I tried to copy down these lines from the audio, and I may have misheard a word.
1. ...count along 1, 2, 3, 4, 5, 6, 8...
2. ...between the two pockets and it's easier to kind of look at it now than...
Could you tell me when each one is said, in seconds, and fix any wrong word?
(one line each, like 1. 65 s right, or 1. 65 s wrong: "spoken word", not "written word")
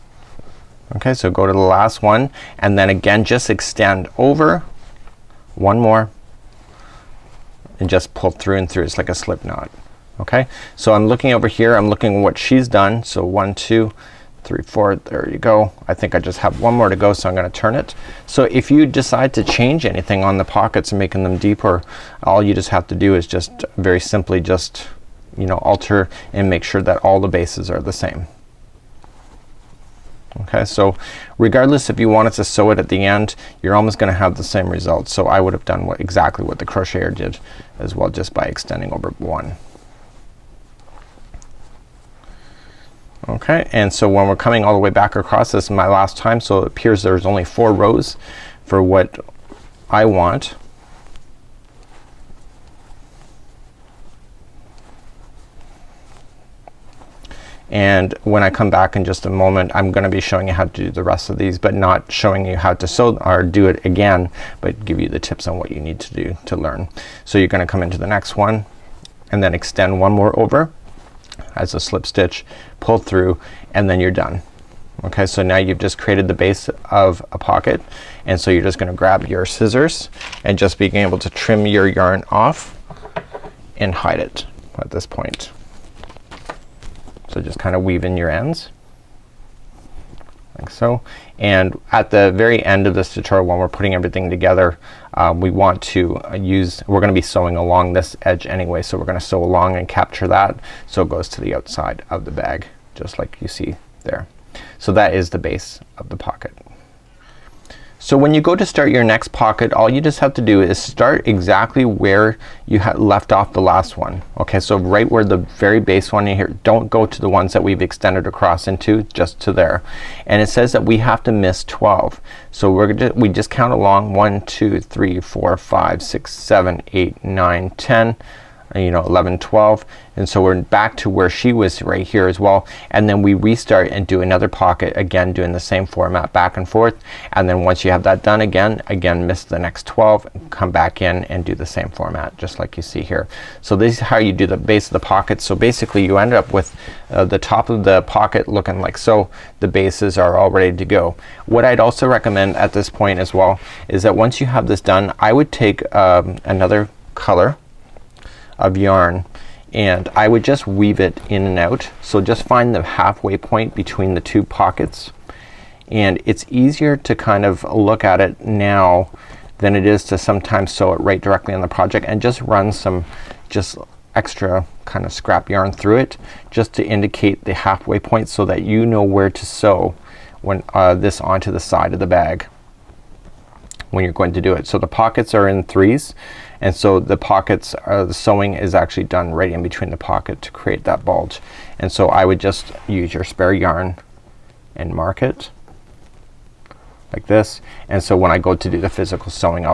1. 123 s wrong: "7", not "8"
2. 163 s right.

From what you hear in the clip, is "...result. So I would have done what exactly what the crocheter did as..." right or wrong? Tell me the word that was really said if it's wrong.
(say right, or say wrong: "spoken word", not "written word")
right.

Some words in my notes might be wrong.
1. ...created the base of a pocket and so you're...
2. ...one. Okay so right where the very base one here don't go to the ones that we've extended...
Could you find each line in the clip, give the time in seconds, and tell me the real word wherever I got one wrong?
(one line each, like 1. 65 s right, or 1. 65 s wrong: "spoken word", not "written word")
1. 75 s right
2. 113 s right.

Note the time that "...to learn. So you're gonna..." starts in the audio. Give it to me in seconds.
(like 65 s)
66 s.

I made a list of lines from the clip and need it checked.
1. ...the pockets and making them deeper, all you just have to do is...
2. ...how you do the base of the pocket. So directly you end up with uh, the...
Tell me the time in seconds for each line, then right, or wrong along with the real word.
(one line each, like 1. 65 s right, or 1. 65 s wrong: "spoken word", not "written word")
1. 20 s right
2. 143 s wrong: "basically", not "directly".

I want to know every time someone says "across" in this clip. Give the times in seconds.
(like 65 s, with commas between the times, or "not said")
45 s, 118 s.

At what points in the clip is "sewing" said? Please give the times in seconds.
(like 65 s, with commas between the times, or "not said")
97 s, 188 s.